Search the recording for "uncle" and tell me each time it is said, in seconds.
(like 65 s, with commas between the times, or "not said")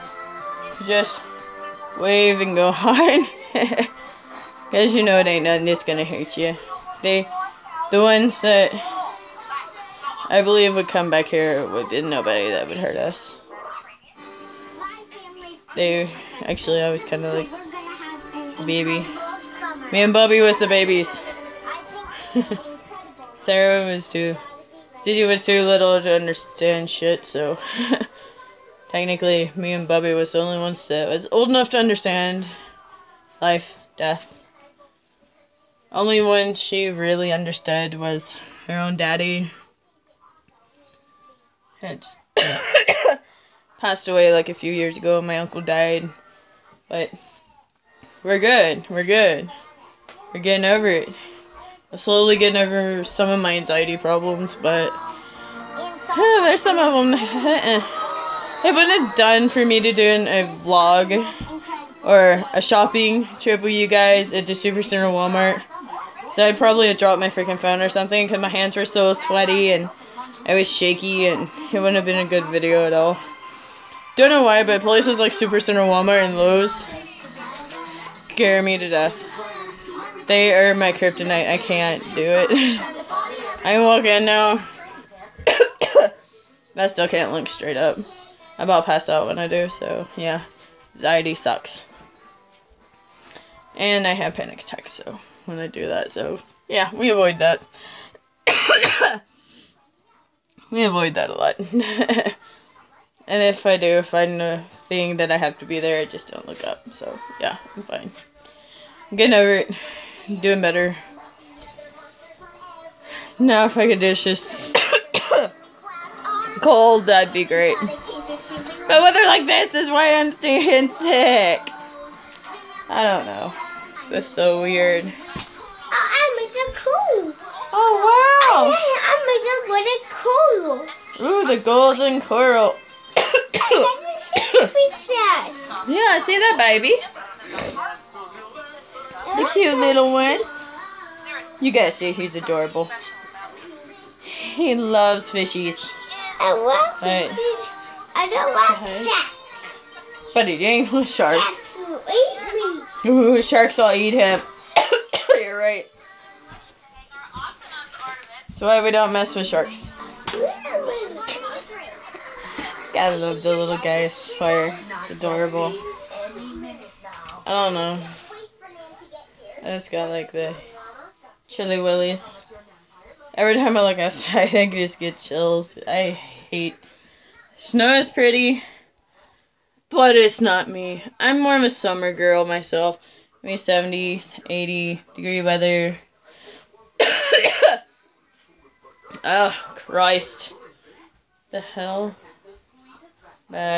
45 s.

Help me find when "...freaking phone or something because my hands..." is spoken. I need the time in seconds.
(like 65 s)
67 s.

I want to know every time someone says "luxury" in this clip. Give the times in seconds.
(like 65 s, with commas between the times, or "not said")
not said.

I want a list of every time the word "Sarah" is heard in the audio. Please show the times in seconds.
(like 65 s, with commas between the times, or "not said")
23 s.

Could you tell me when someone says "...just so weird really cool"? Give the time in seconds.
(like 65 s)
124 s.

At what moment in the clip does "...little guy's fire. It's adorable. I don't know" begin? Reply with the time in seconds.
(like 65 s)
163 s.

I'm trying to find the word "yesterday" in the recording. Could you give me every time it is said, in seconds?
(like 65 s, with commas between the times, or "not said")
not said.